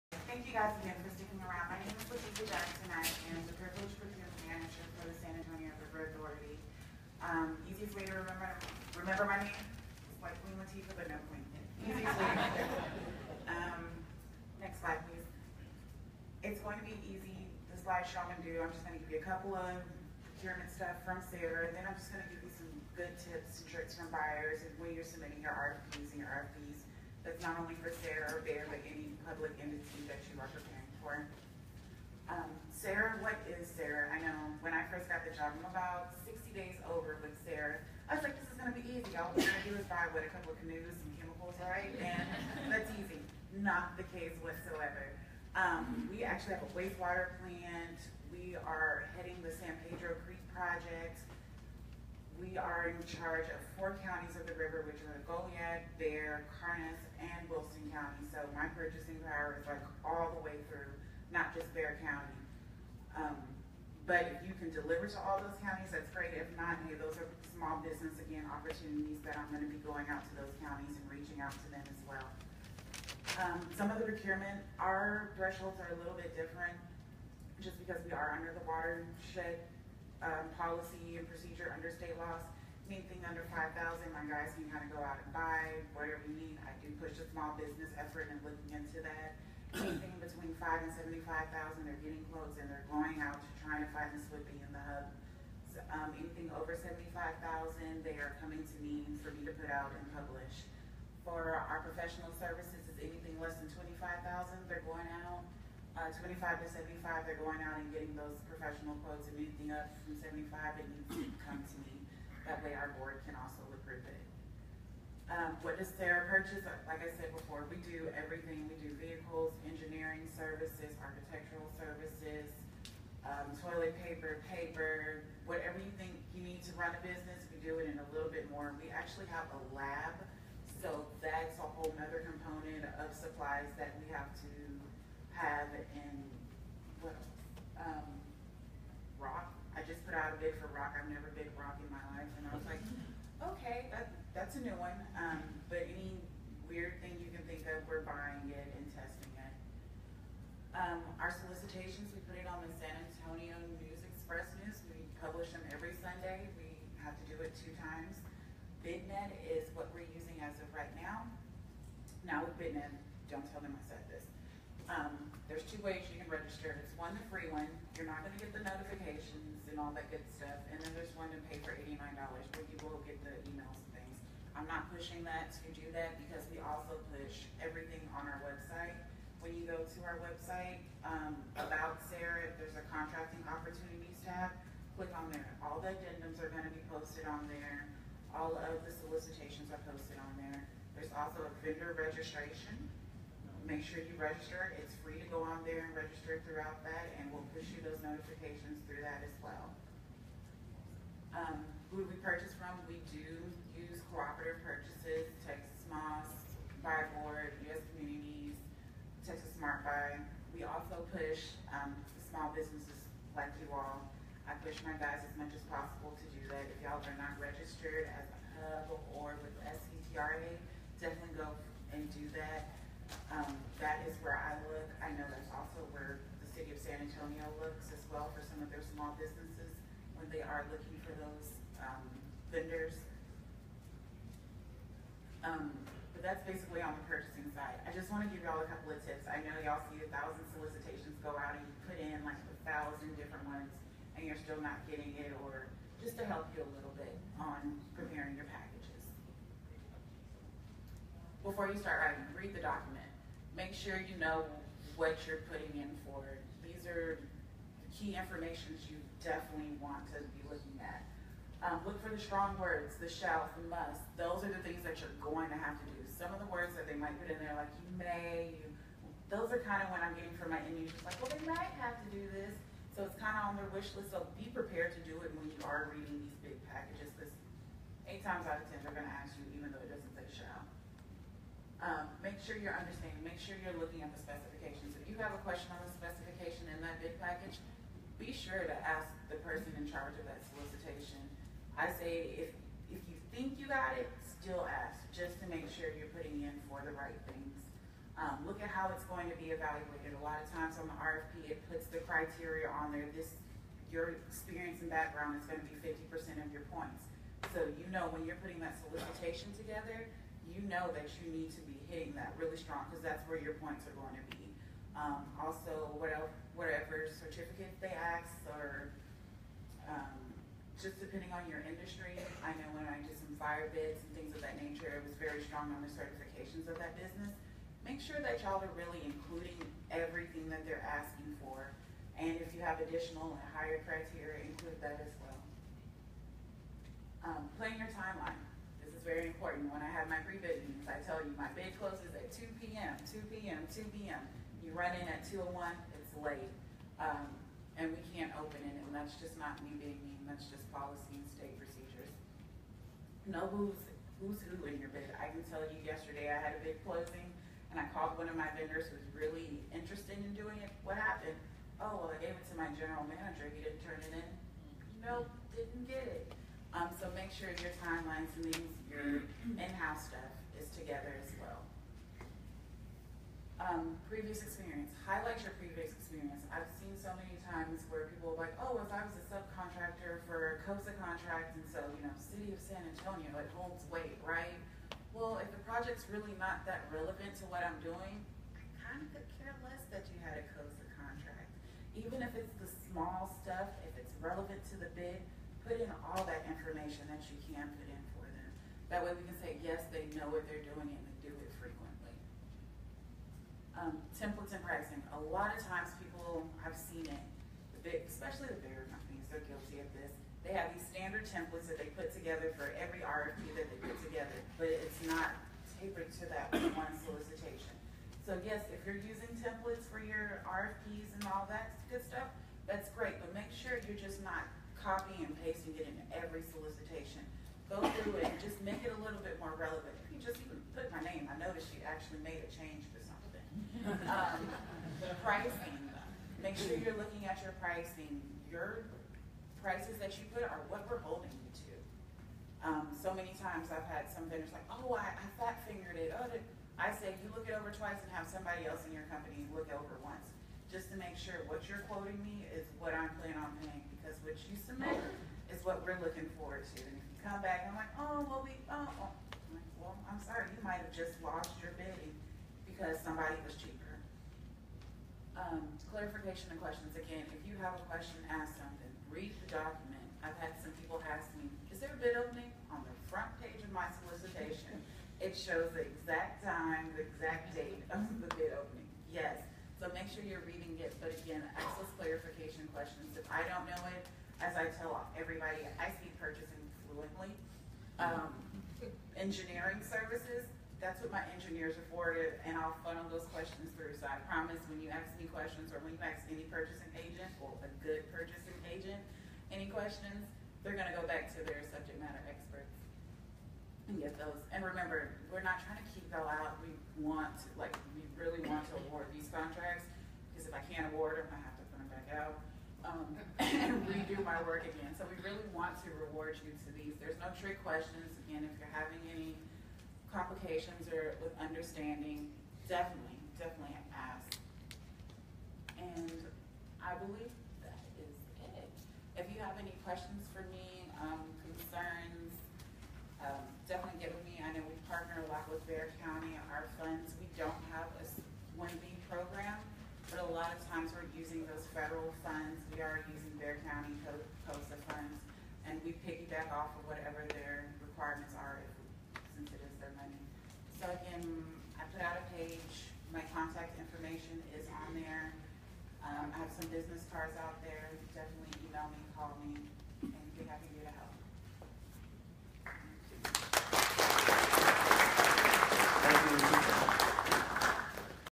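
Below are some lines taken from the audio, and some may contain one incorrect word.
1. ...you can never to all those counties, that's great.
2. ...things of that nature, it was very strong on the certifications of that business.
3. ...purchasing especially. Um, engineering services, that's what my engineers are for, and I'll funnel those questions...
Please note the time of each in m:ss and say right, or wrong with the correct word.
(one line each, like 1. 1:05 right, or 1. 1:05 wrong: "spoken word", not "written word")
1. 1:04 wrong: "deliver", not "never"
2. 5:24 right
3. 8:06 wrong: "fluently", not "especially".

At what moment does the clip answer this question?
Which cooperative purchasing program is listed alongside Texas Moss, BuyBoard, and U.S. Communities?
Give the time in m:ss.
3:29.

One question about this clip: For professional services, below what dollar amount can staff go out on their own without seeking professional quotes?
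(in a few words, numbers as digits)
25,000.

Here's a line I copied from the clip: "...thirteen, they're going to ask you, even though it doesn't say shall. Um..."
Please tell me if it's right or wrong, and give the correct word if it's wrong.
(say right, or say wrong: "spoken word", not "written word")
wrong: "ten", not "thirteen".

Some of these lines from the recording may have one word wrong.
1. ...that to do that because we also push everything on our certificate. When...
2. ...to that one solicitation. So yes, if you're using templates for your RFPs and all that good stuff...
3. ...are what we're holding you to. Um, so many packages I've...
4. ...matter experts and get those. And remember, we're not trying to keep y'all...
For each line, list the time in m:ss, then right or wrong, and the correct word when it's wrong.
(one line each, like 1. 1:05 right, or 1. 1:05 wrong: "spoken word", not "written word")
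1. 2:55 wrong: "website", not "certificate"
2. 6:56 right
3. 7:20 wrong: "times", not "packages"
4. 8:22 right.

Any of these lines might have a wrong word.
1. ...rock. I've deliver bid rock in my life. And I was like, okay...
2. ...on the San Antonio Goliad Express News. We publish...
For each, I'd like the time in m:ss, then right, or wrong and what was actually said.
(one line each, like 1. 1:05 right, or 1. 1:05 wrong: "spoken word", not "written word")
1. 2:20 wrong: "never", not "deliver"
2. 2:32 wrong: "News", not "Goliad".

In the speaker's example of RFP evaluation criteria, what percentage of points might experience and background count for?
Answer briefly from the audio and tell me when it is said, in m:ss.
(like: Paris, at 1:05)
50%, at 5:05.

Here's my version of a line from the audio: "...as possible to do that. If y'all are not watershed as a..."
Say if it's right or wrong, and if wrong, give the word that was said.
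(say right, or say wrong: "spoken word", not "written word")
wrong: "registered", not "watershed".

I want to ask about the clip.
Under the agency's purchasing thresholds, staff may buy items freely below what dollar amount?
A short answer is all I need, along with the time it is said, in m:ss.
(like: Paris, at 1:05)
5,000, at 1:23.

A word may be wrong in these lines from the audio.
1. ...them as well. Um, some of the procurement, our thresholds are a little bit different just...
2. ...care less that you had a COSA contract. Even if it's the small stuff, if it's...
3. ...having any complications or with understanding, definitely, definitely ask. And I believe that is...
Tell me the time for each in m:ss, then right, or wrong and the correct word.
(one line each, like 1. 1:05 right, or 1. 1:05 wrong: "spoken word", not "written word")
1. 1:11 right
2. 6:29 right
3. 8:38 right.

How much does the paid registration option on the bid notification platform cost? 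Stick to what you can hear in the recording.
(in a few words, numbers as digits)
$89.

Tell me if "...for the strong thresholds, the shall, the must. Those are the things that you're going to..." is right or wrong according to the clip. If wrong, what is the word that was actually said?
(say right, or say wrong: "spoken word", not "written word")
wrong: "words", not "thresholds".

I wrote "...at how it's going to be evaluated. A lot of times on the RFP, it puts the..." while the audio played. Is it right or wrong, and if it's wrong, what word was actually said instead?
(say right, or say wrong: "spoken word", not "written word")
right.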